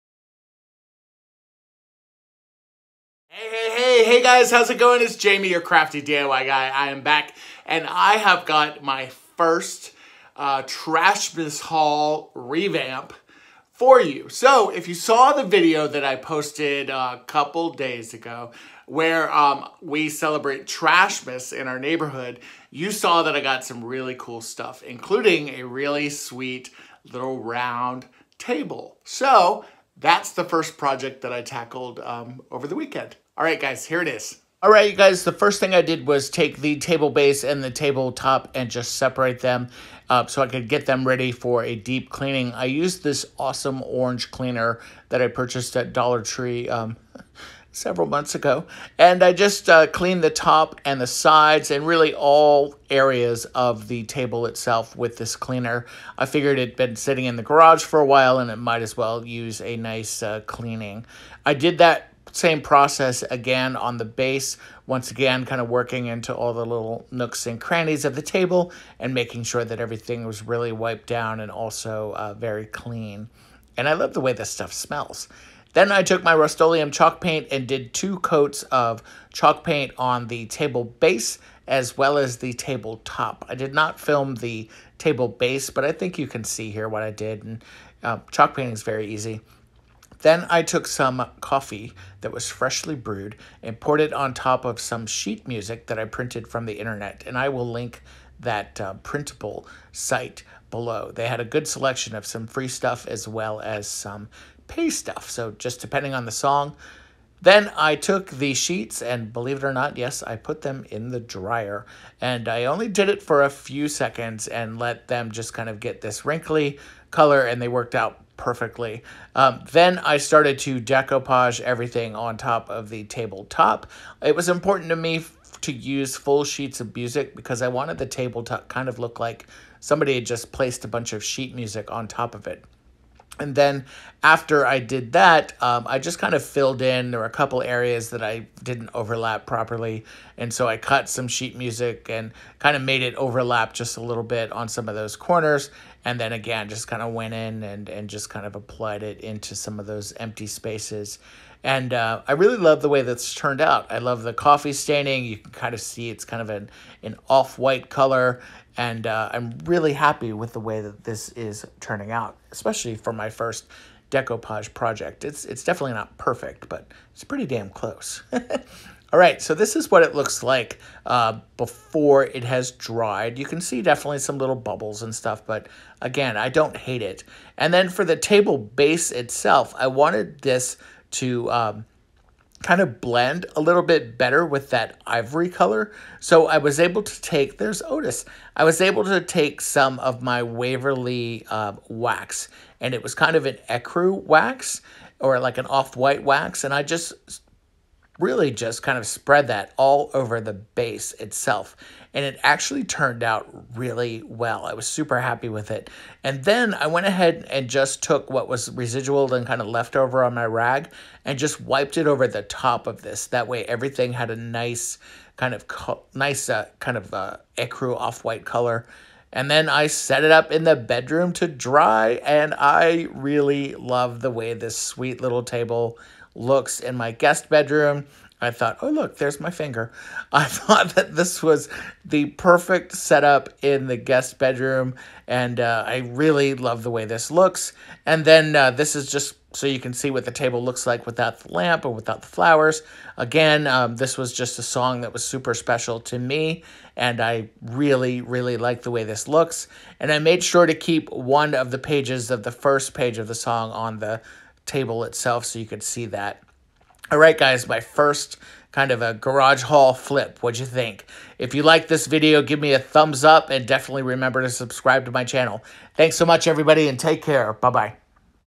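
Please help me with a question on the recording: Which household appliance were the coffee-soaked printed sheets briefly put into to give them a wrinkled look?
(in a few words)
Dryer.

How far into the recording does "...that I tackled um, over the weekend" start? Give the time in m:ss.
0:31.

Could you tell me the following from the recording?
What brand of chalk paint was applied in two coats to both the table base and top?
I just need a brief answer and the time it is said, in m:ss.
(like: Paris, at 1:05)
Rust-Oleum, at 1:16.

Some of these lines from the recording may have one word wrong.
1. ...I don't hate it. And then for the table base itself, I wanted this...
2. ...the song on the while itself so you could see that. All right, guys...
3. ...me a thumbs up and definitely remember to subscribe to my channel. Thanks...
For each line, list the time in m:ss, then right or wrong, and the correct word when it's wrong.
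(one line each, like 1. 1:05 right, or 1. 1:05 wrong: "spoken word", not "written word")
1. 2:56 right
2. 4:13 wrong: "table", not "while"
3. 4:22 right.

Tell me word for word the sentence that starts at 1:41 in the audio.
They had a good selection of some free stuff as well as some pay stuff.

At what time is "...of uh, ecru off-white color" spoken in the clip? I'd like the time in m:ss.
3:36.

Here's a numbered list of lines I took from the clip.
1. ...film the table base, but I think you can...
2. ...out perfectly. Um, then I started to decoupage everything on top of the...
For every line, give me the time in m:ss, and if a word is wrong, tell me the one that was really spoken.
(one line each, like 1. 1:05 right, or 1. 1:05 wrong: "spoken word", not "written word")
1. 1:23 right
2. 1:57 right.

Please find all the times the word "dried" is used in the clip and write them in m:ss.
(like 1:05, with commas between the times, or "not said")
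2:52.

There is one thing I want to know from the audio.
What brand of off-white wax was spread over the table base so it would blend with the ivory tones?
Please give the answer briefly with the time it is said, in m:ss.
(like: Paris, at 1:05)
Waverly, at 3:10.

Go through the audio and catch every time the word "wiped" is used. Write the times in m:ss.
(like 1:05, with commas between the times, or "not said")
1:10, 3:31.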